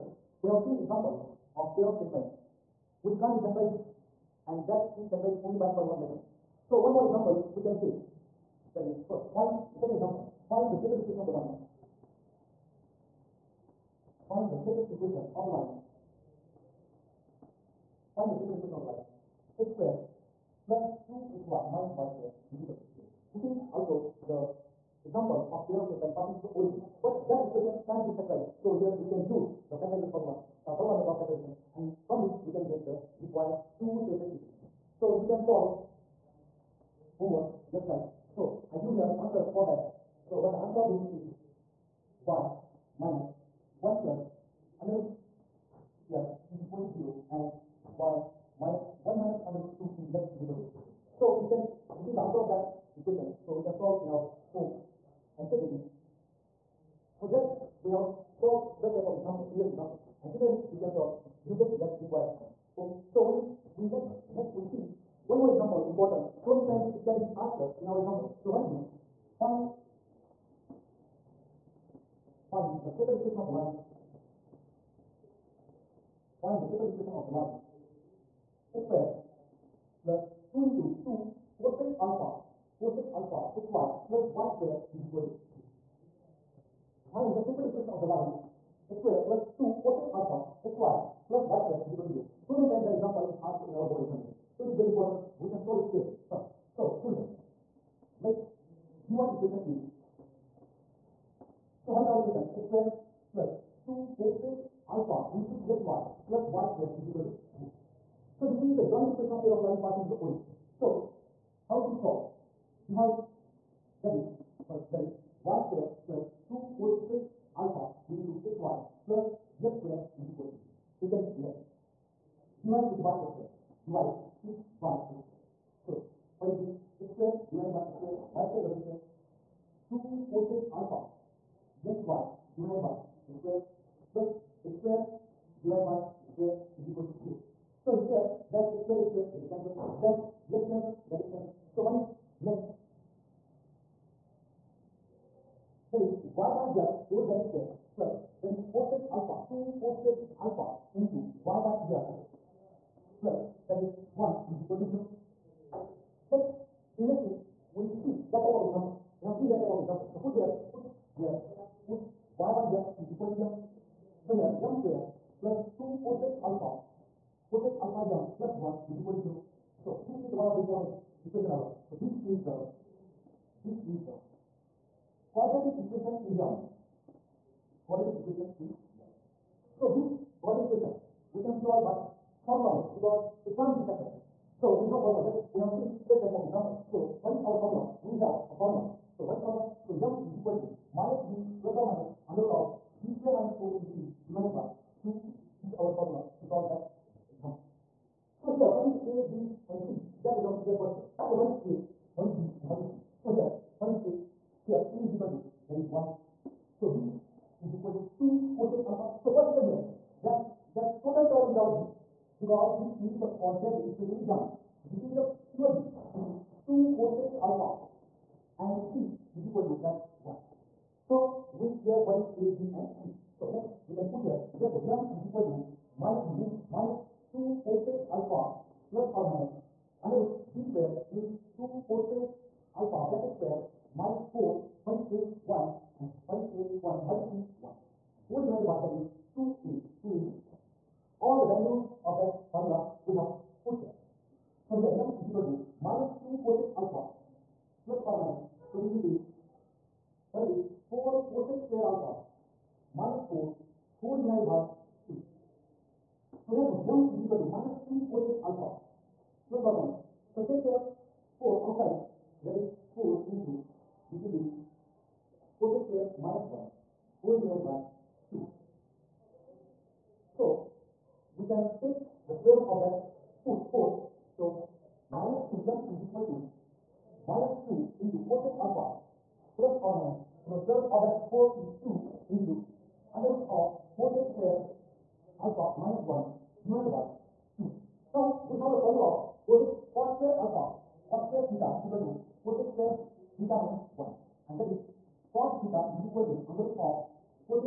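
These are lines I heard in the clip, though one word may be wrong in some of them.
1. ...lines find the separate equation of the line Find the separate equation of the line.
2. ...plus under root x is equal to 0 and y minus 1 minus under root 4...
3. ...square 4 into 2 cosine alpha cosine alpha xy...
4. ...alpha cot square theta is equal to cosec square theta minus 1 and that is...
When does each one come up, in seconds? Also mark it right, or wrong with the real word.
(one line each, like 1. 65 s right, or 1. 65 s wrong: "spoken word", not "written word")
1. 11 s right
2. 44 s wrong: "2", not "4"
3. 78 s wrong: "2", not "4"
4. 290 s right.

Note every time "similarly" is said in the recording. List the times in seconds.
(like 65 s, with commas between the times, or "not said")
60 s.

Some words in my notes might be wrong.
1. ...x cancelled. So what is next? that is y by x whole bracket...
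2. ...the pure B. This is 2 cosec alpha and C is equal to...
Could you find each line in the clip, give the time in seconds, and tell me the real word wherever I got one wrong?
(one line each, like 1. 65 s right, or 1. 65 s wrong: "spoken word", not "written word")
1. 141 s right
2. 215 s right.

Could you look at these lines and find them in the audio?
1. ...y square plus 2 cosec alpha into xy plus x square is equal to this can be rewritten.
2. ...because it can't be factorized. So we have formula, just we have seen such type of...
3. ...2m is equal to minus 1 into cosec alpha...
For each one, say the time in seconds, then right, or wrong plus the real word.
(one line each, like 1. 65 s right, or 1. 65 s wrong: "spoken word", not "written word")
1. 115 s right
2. 182 s right
3. 275 s wrong: "2", not "1".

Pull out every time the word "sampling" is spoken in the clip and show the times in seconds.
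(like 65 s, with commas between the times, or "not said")
not said.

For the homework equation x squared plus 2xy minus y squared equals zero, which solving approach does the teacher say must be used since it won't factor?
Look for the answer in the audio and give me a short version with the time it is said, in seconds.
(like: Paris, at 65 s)
formula method of factorization, at 30 s.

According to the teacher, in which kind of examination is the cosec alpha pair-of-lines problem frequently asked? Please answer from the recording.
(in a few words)
board examination.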